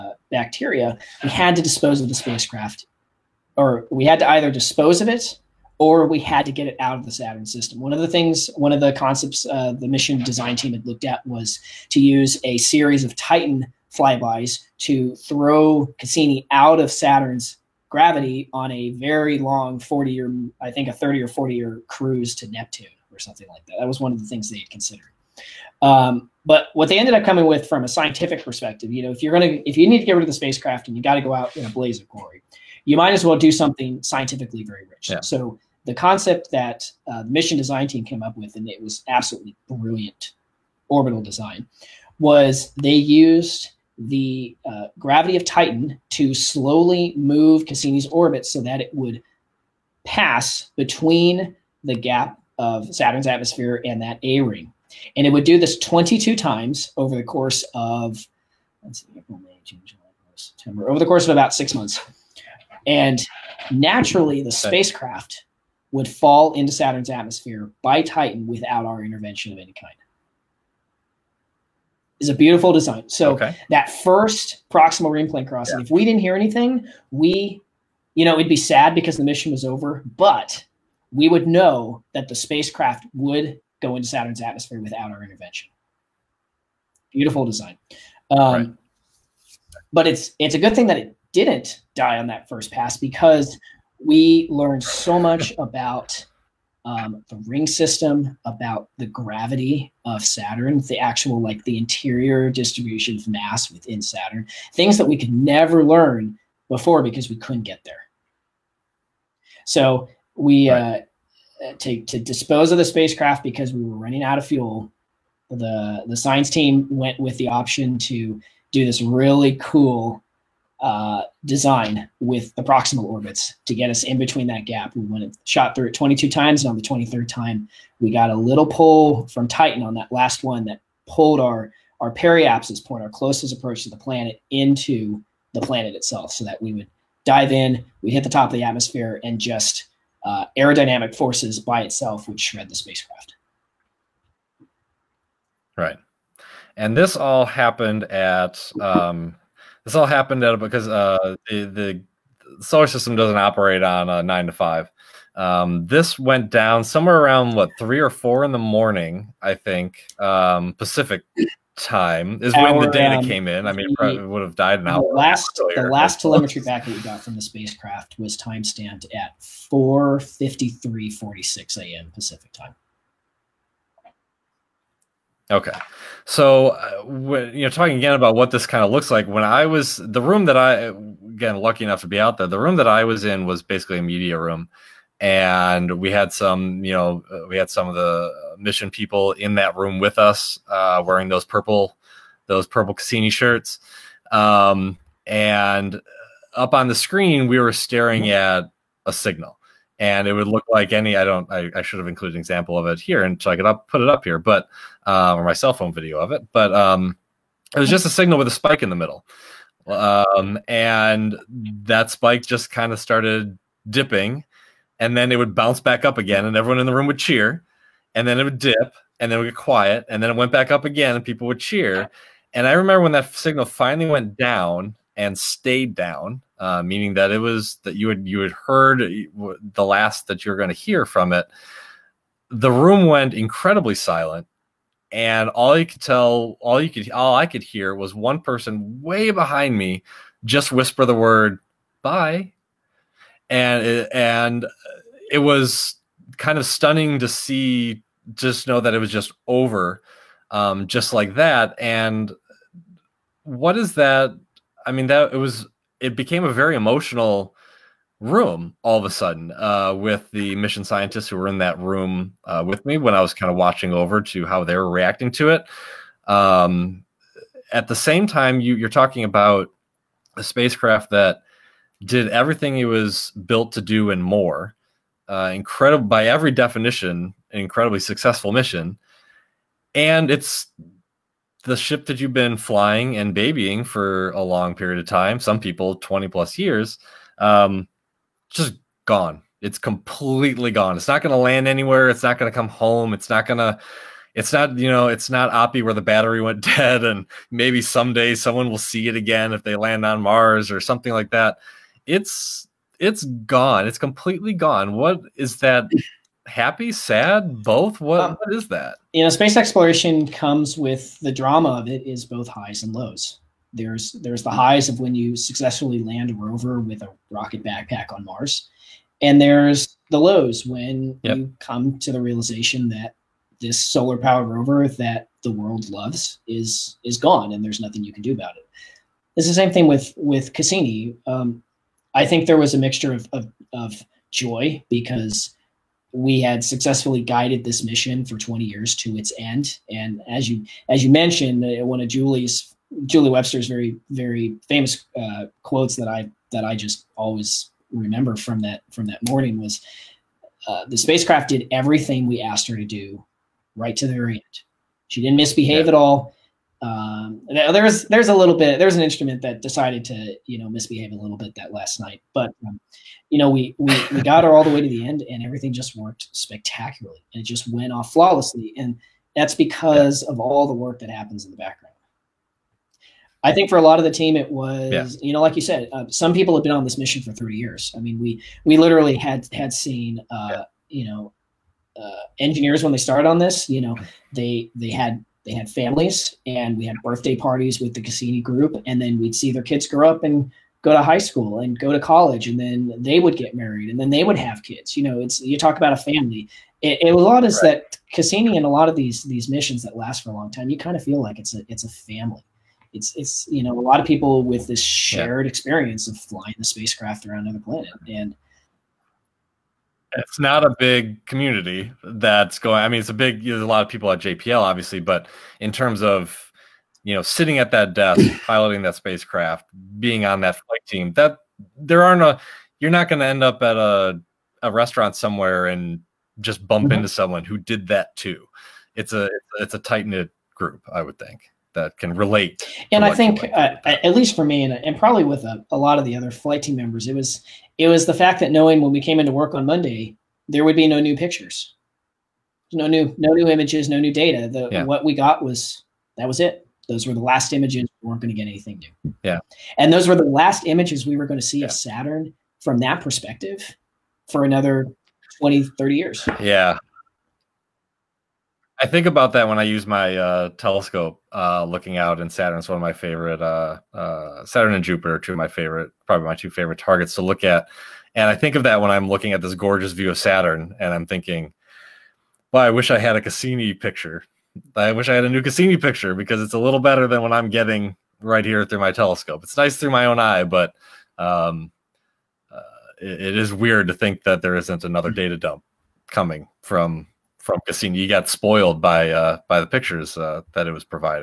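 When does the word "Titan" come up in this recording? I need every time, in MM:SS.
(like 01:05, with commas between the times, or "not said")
00:13, 00:45, 01:08, 02:09.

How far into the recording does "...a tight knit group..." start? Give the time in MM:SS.
07:09.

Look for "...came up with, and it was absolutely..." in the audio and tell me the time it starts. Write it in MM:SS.
00:38.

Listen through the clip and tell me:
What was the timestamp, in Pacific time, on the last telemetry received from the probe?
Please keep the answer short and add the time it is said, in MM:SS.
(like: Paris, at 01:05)
4:53:46 a.m., at 02:49.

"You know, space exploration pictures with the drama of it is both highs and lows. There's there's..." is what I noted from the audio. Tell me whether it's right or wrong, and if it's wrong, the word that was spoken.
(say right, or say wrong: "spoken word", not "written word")
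wrong: "comes", not "pictures".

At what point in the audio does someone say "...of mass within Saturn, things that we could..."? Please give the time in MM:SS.
01:43.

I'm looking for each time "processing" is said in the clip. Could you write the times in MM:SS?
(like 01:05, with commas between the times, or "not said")
not said.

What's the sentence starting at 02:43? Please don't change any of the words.
I mean, the, would have died an hour.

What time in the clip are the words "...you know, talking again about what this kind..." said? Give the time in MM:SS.
02:57.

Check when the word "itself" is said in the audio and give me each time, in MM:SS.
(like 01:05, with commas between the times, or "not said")
02:15, 02:21.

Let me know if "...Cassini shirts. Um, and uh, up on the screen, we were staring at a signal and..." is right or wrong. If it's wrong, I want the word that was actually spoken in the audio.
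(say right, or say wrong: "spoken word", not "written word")
right.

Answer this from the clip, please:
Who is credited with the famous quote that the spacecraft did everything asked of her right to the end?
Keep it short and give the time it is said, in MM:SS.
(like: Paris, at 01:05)
Julie Webster, at 05:43.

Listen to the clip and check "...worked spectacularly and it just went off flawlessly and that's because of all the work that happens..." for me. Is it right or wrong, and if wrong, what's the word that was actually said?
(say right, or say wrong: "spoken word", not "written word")
right.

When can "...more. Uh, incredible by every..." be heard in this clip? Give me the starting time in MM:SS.
04:34.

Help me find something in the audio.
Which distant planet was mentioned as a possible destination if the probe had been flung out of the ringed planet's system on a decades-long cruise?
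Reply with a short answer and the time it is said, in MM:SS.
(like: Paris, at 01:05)
Neptune, at 00:22.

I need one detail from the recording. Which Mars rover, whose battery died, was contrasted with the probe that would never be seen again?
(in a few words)
Oppie.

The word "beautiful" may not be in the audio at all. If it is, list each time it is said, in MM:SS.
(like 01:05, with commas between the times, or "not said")
01:12, 01:27.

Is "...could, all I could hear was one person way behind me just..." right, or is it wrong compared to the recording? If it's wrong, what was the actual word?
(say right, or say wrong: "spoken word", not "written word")
right.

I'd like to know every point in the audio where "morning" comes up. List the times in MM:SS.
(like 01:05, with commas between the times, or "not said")
02:38, 05:49.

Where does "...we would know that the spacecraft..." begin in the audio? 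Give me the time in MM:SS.
01:21.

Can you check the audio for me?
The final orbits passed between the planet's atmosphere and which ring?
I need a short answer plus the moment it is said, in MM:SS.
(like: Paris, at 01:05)
A ring, at 00:54.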